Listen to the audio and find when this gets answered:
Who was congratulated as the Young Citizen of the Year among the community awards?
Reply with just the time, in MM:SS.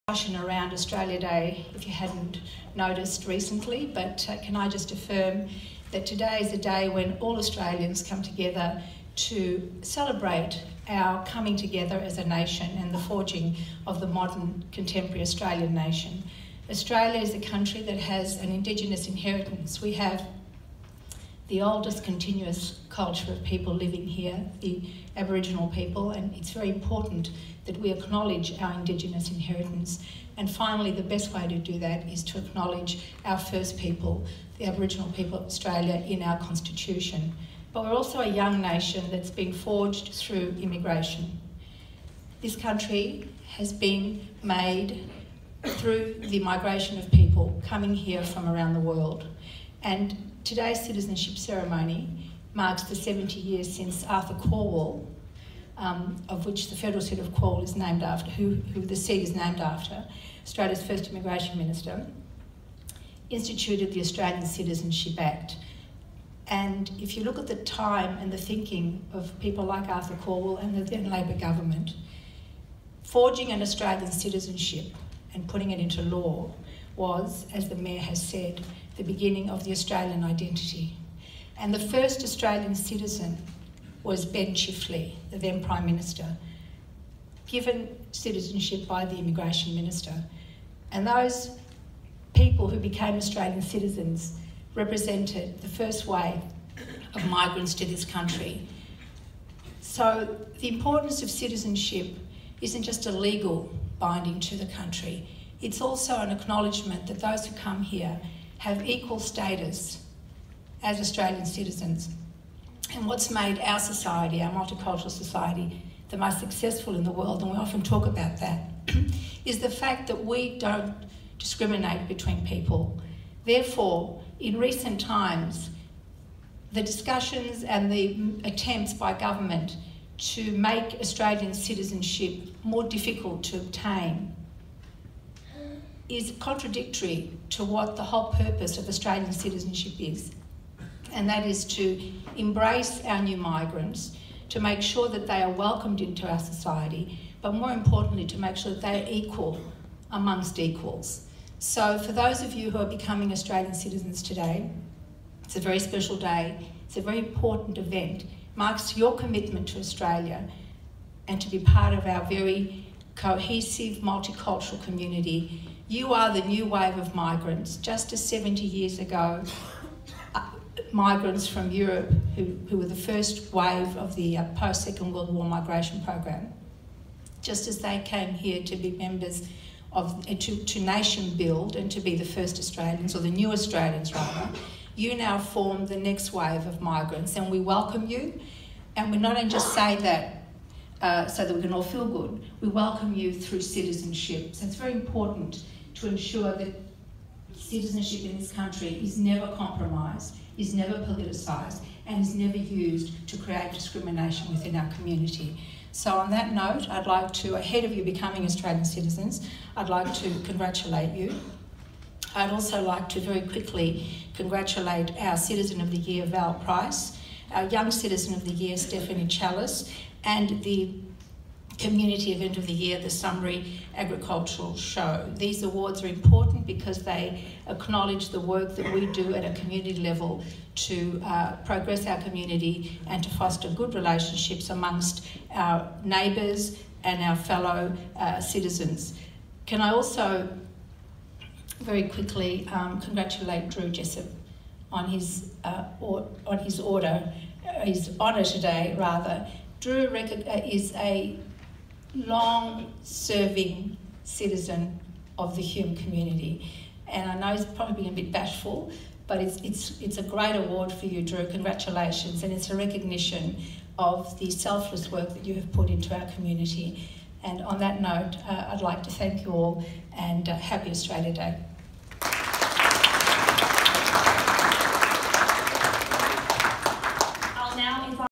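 03:38.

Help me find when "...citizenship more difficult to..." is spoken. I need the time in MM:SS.
02:11.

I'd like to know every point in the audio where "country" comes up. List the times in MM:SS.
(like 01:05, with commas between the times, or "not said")
00:17, 00:42, 01:38, 01:44, 03:18.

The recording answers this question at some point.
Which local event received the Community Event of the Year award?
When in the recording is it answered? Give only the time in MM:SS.
03:43.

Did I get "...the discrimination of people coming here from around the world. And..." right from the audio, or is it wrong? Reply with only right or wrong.
wrong.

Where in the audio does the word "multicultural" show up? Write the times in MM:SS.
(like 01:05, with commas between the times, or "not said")
01:54, 02:43.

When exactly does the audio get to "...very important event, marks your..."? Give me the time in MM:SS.
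02:37.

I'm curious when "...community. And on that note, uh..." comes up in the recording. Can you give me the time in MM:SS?
04:26.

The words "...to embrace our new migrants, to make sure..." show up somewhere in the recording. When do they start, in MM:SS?
02:21.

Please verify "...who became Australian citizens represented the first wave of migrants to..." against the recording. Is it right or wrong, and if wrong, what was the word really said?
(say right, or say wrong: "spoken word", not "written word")
right.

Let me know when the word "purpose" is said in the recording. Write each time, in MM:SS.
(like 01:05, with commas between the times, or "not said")
02:18.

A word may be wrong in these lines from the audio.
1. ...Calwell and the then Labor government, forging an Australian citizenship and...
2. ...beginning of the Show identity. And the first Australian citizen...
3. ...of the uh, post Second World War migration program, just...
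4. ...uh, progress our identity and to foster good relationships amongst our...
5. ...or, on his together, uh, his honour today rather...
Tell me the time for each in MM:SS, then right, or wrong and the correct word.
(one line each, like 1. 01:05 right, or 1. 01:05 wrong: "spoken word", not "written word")
1. 01:10 right
2. 01:19 wrong: "Australian", not "Show"
3. 02:53 right
4. 03:51 wrong: "community", not "identity"
5. 04:05 wrong: "order", not "together".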